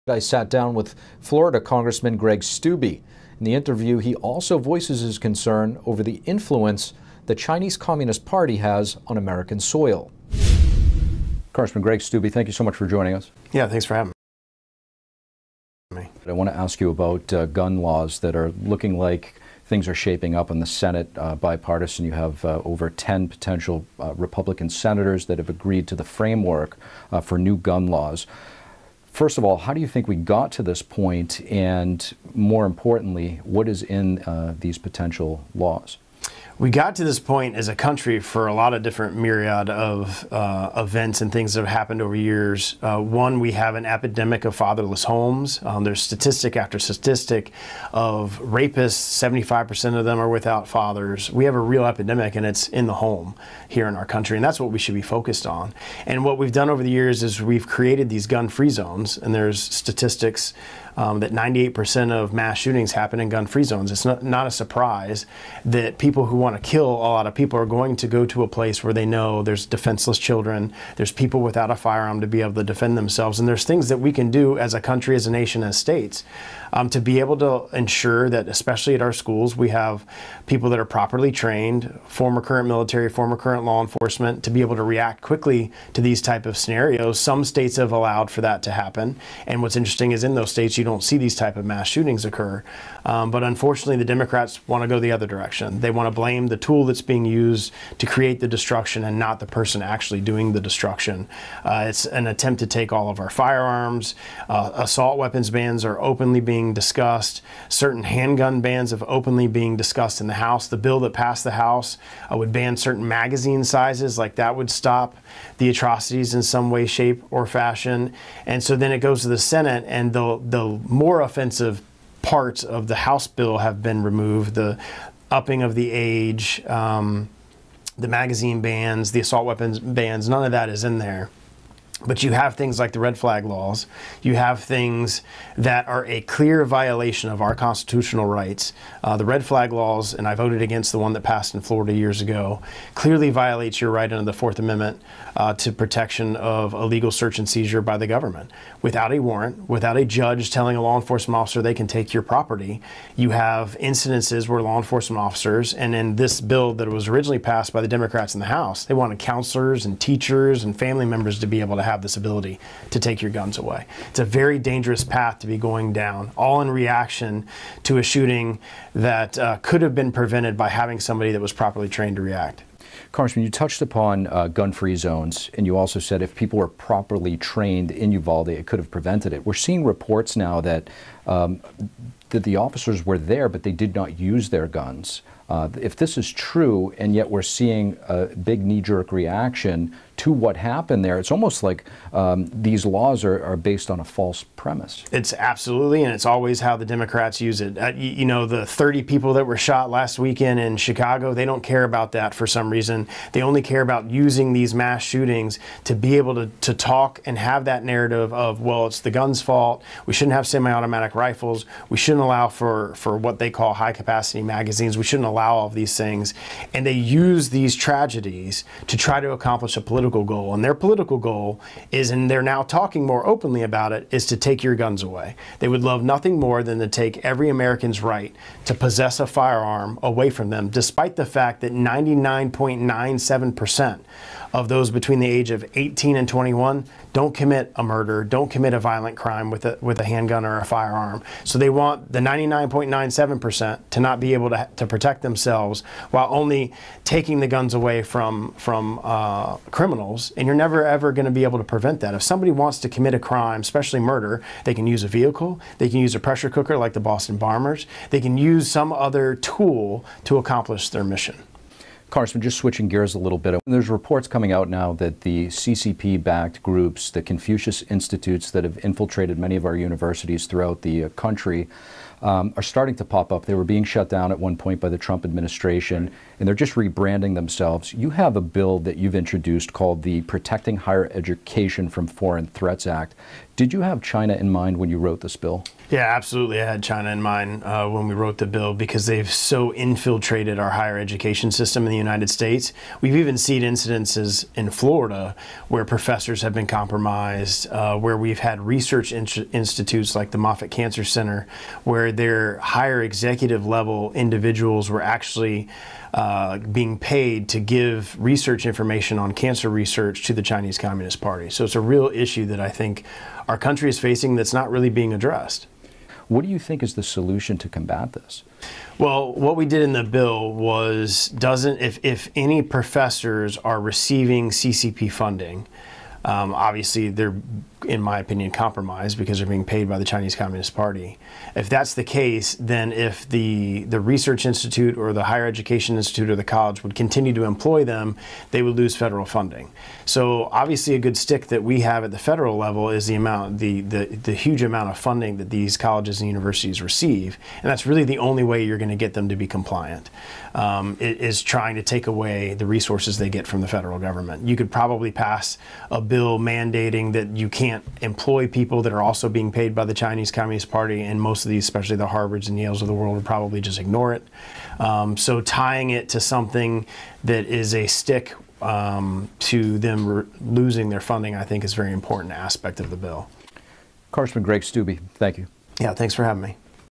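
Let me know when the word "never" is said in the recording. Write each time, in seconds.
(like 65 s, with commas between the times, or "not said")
250 s.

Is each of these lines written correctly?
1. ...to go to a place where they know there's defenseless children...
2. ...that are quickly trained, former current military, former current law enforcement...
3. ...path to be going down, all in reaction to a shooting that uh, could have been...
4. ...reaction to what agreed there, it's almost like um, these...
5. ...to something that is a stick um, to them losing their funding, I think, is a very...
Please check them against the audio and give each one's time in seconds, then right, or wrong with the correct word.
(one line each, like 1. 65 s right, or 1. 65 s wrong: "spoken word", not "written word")
1. 67 s right
2. 80 s wrong: "properly", not "quickly"
3. 165 s right
4. 189 s wrong: "happened", not "agreed"
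5. 366 s right.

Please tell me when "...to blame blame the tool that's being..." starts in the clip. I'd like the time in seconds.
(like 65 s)
96 s.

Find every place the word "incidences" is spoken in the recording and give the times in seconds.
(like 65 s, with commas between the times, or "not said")
153 s, 293 s.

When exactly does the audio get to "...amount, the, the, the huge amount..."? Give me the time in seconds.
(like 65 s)
343 s.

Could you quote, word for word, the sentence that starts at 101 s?
Uh, it's an attempt to take all of our firearms.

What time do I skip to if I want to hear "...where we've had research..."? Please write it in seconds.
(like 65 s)
297 s.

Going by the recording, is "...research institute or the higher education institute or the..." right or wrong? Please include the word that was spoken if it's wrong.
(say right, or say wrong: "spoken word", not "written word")
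right.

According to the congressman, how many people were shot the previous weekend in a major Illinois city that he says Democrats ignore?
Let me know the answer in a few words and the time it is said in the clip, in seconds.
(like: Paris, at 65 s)
30, at 198 s.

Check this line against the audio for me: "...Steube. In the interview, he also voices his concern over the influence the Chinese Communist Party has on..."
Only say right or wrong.
right.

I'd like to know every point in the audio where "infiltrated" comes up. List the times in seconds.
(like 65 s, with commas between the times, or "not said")
268 s, 289 s.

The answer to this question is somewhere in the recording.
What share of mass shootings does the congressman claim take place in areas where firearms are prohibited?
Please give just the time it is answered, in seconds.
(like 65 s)
61 s.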